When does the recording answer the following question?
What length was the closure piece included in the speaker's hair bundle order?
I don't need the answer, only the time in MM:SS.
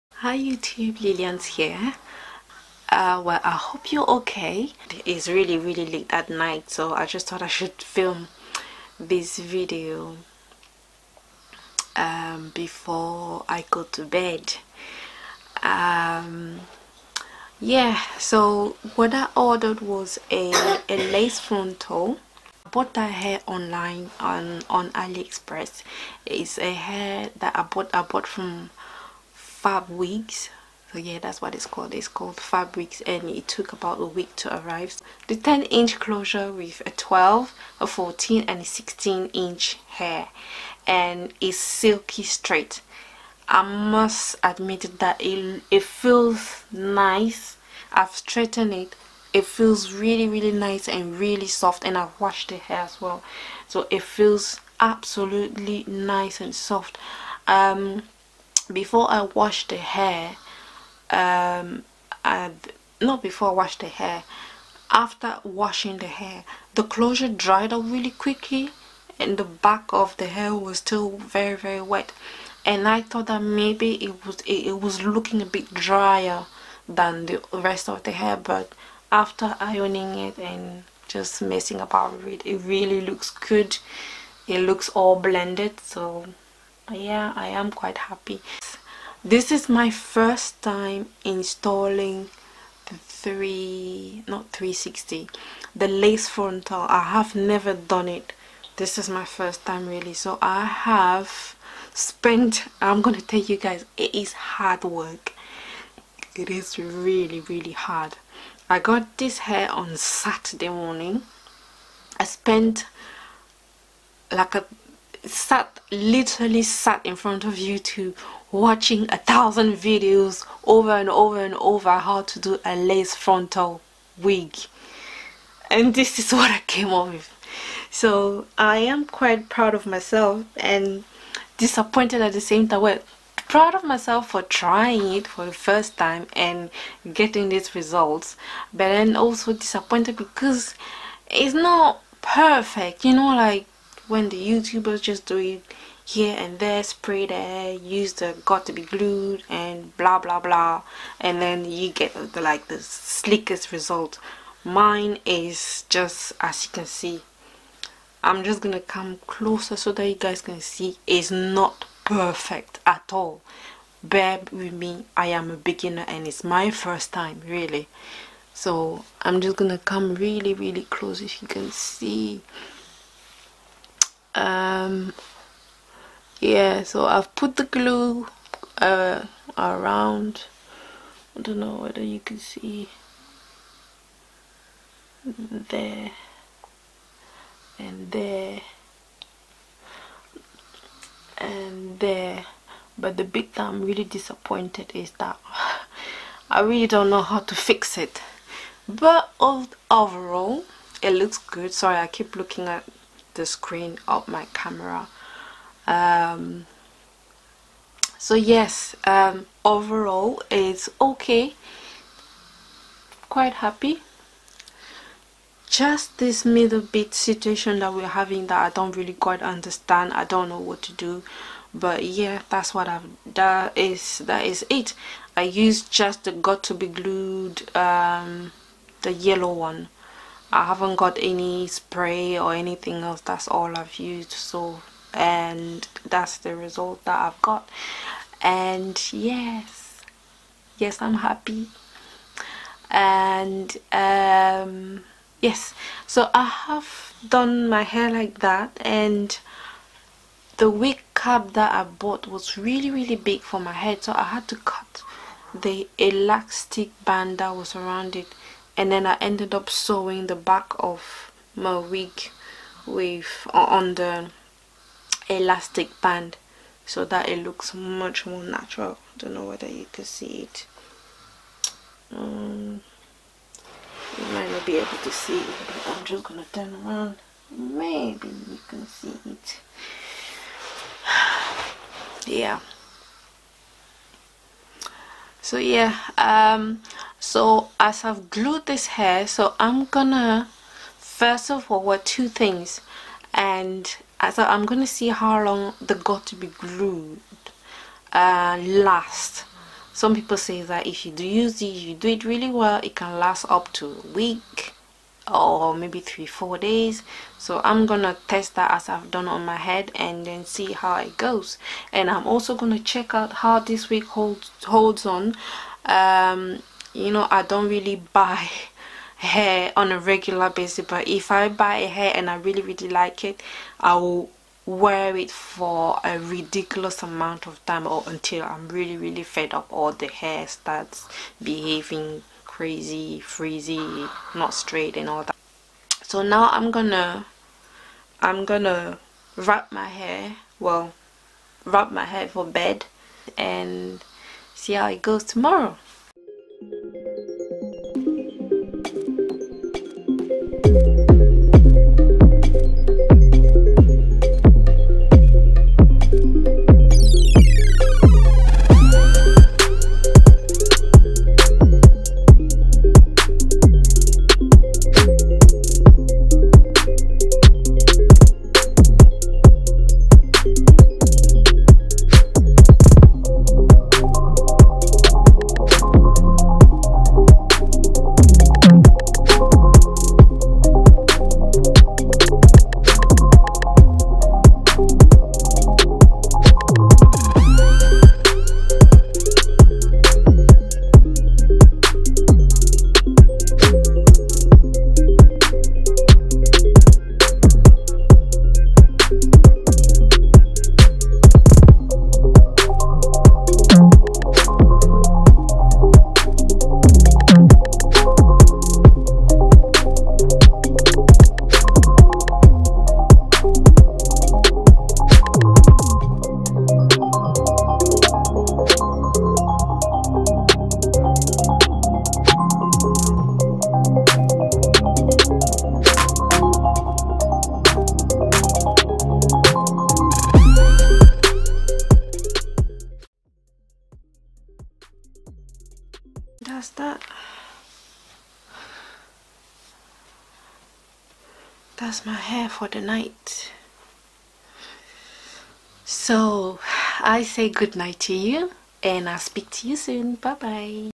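00:35.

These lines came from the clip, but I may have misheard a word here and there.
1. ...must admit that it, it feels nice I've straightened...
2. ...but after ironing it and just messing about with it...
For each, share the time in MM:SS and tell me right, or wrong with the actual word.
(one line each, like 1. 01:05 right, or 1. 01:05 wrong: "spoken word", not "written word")
1. 00:43 right
2. 01:18 right.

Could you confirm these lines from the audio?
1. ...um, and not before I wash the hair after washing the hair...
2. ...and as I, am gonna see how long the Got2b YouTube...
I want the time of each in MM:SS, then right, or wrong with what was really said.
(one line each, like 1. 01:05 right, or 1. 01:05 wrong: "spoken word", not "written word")
1. 01:01 right
2. 04:53 wrong: "Glued", not "YouTube".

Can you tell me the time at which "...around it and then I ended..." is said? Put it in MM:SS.
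04:17.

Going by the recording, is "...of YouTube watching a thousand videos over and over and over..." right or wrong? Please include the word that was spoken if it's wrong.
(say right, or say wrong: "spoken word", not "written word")
right.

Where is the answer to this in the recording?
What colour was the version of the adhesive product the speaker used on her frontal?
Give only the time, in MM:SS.
03:49.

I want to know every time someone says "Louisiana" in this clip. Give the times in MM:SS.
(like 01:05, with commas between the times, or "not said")
not said.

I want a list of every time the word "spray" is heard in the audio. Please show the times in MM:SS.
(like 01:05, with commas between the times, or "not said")
02:26, 03:51.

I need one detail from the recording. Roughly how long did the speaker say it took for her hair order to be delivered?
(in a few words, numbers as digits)
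about a week.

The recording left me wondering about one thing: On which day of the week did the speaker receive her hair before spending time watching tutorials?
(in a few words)
Saturday.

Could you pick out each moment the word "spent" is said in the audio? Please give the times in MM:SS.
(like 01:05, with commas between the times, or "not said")
01:41, 01:52.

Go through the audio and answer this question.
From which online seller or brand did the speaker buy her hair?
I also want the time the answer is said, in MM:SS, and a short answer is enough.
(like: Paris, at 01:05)
FabWigs, at 00:32.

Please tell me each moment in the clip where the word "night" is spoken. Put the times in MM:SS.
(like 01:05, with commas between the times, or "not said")
00:06, 07:22, 07:27.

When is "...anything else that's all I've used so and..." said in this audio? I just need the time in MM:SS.
03:52.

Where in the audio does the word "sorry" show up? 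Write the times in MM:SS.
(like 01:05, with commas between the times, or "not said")
03:21.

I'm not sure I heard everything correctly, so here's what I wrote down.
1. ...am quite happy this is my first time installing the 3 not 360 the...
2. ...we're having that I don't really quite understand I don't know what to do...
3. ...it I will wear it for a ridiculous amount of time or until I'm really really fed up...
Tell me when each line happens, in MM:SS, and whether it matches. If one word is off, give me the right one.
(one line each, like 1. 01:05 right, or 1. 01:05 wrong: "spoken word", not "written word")
1. 01:27 right
2. 03:37 right
3. 05:23 right.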